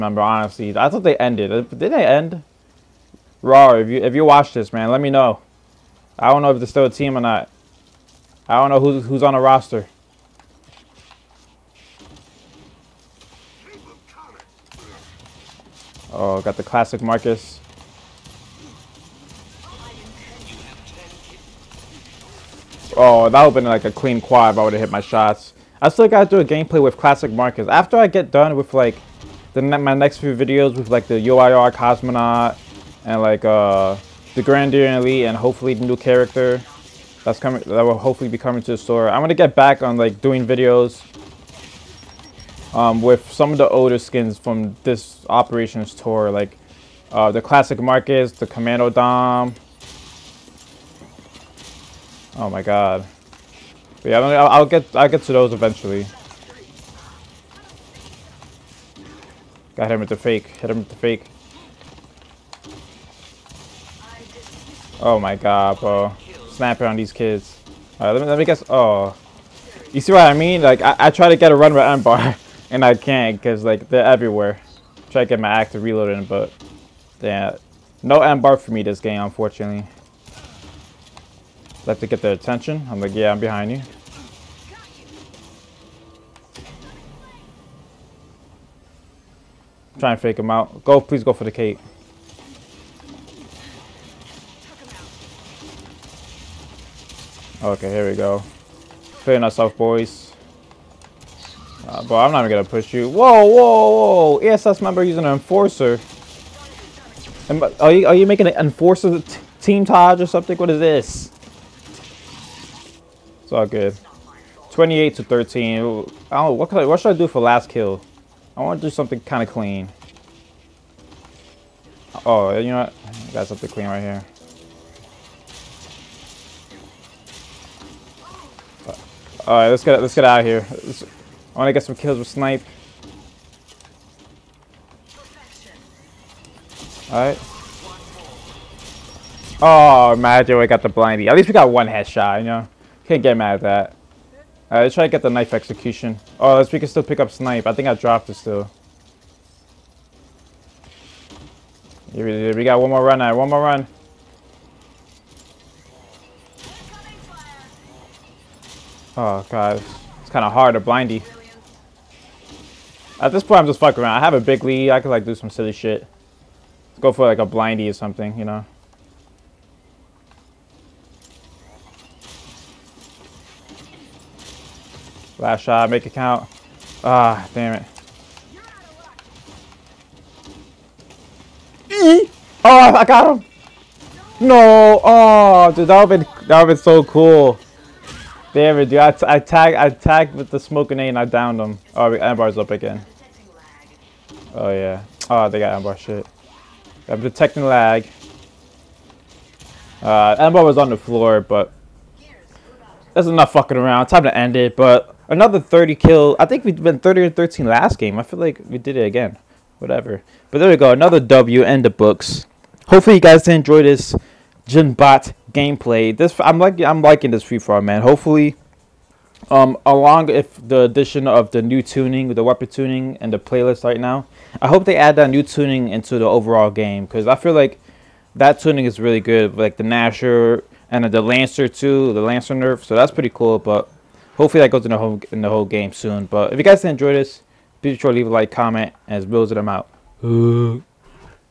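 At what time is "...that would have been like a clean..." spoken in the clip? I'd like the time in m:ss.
0:23.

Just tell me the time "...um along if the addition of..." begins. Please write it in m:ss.
3:39.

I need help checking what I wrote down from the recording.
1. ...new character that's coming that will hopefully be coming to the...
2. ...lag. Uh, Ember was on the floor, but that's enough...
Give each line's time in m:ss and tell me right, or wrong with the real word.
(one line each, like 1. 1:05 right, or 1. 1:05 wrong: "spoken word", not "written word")
1. 0:35 right
2. 3:17 right.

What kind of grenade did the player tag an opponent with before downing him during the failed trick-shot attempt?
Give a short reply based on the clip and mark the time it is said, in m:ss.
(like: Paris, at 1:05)
smoke grenade, at 3:10.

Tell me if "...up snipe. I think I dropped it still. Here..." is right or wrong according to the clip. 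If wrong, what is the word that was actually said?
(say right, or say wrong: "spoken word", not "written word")
right.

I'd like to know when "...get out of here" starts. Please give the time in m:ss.
2:10.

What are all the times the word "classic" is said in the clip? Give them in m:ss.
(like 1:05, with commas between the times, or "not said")
0:16, 0:26, 0:47.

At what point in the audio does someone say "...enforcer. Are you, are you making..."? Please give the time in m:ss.
1:45.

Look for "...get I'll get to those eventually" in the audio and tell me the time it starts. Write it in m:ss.
0:54.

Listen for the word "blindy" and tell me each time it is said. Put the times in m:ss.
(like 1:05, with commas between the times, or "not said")
2:20, 2:40, 2:47.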